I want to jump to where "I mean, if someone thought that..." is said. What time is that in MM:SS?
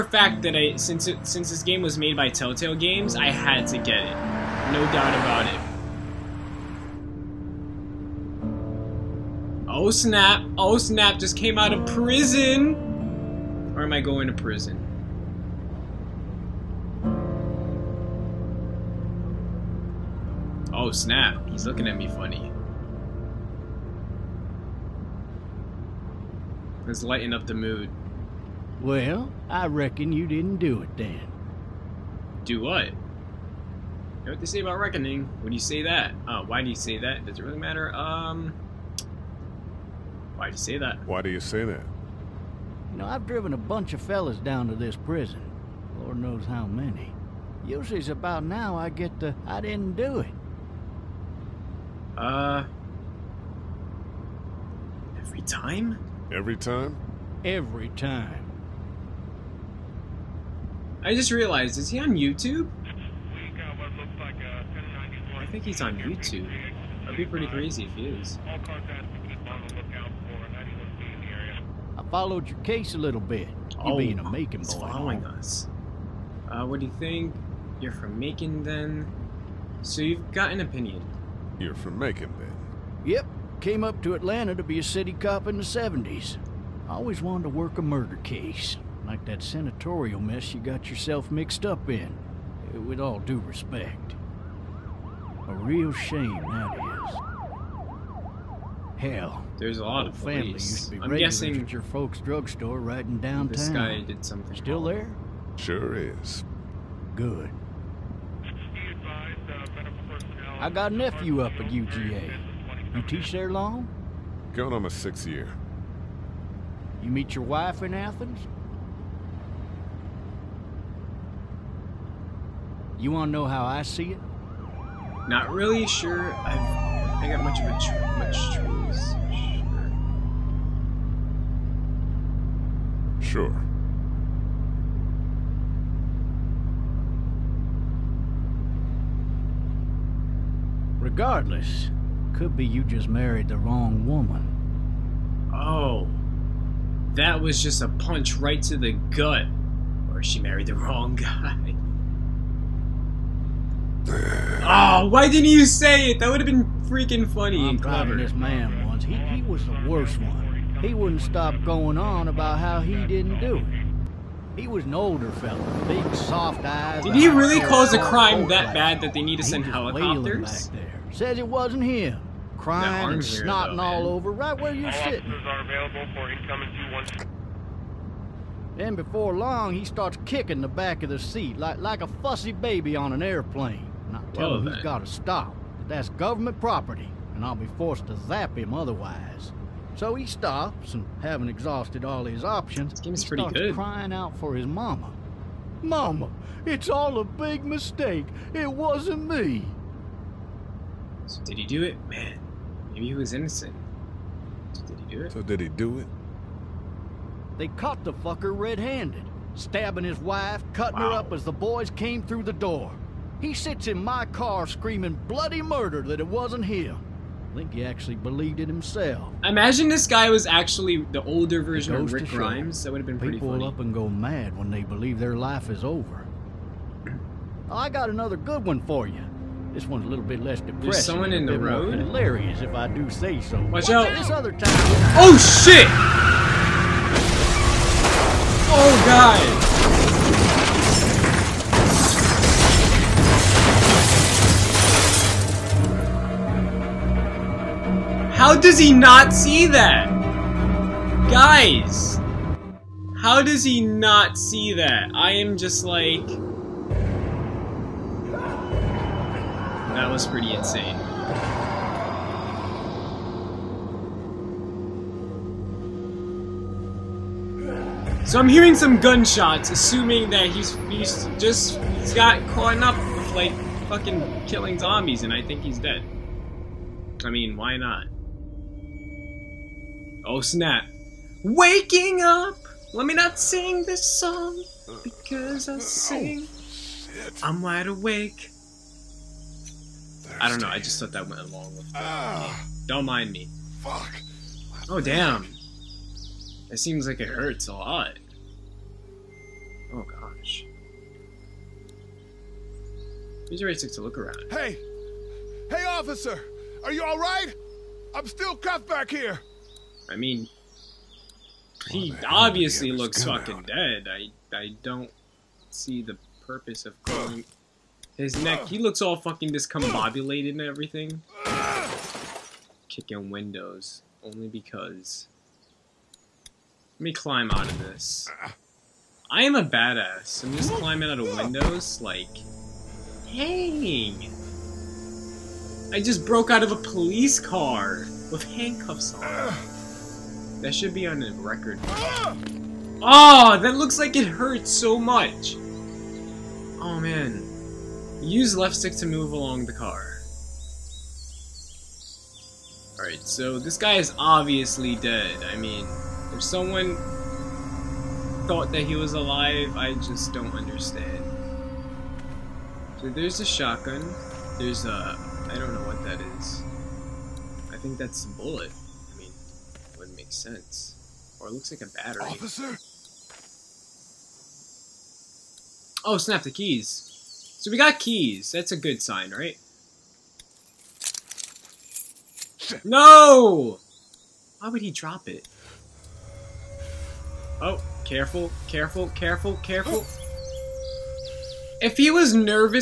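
05:55.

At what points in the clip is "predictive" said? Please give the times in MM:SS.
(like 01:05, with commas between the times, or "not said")
not said.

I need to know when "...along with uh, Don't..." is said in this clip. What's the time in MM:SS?
04:51.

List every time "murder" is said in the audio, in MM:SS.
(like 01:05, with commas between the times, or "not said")
01:27, 03:35.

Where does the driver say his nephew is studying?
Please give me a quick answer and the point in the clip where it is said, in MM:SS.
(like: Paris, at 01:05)
UGA, at 01:51.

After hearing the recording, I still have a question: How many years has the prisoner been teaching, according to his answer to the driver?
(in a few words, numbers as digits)
6.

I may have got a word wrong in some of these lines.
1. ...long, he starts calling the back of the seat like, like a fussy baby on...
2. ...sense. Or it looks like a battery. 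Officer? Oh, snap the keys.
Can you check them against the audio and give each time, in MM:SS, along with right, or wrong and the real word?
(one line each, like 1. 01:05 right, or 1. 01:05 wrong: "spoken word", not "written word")
1. 02:59 wrong: "kicking", not "calling"
2. 06:10 right.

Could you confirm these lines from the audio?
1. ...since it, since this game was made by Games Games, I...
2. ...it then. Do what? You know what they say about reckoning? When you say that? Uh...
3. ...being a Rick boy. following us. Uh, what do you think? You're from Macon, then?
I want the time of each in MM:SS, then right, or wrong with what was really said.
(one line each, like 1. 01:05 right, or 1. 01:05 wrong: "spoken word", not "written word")
1. 00:00 wrong: "Telltale", not "Games"
2. 00:30 right
3. 01:13 wrong: "Macon", not "Rick".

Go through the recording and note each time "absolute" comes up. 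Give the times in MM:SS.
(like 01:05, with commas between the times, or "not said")
not said.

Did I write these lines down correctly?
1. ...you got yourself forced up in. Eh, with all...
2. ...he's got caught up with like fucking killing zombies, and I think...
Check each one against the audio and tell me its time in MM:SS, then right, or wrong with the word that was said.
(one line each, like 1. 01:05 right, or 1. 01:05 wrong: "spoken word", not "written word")
1. 01:30 wrong: "mixed", not "forced"
2. 04:31 right.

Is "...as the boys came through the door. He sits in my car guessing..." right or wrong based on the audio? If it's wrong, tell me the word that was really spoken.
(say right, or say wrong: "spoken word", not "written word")
wrong: "screaming", not "guessing".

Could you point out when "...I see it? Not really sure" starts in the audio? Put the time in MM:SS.
02:03.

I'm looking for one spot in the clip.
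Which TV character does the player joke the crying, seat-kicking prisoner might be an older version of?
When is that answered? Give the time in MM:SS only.
03:42.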